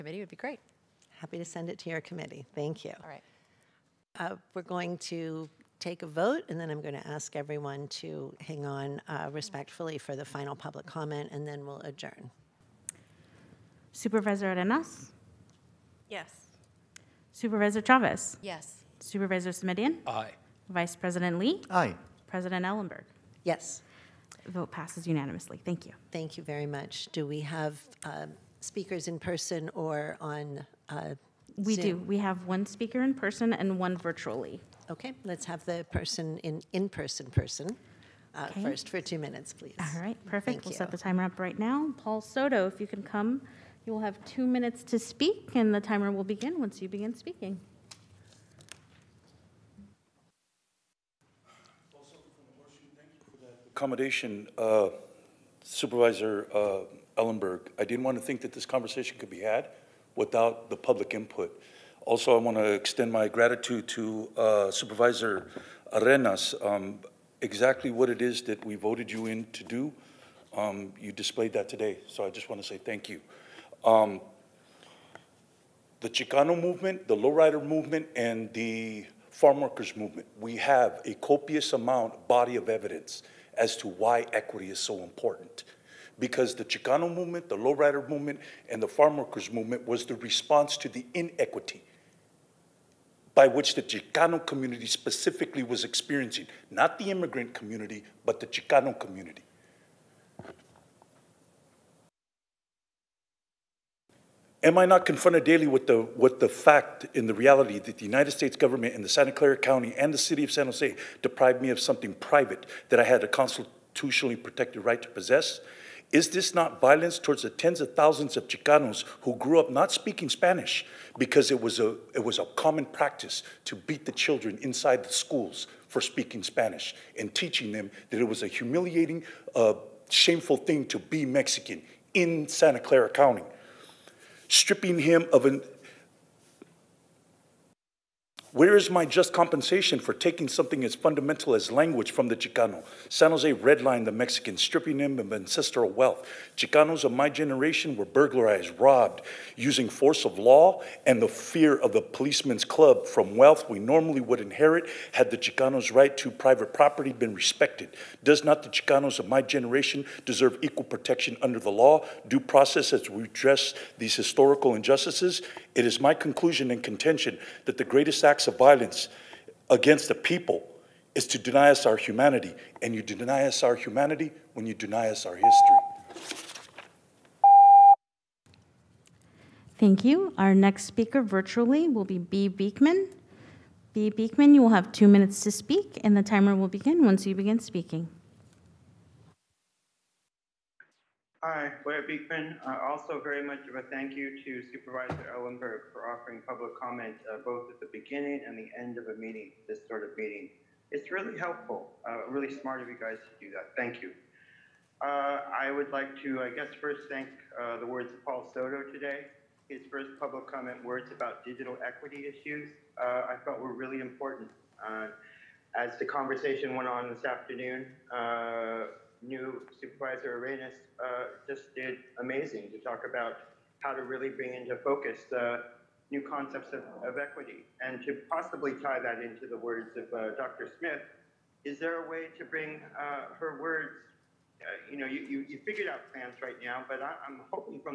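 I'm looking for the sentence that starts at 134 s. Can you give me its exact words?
stripping him of an where is my just compensation for taking something as fundamental as language from the Chicano?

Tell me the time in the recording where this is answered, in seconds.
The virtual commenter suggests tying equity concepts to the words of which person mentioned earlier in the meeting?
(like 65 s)
230 s.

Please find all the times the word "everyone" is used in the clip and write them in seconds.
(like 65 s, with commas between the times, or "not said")
7 s.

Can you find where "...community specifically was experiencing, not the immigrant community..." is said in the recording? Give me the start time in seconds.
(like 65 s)
94 s.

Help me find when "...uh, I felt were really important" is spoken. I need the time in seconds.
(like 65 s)
213 s.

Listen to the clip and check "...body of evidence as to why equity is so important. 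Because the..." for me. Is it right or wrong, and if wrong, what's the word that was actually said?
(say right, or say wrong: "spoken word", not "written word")
right.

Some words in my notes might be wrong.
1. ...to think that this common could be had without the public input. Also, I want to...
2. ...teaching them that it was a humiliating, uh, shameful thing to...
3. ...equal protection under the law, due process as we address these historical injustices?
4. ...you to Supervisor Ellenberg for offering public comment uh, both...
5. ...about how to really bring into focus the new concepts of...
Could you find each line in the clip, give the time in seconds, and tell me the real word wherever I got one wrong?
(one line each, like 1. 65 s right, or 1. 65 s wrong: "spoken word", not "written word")
1. 58 s wrong: "conversation", not "common"
2. 127 s right
3. 160 s right
4. 194 s right
5. 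223 s right.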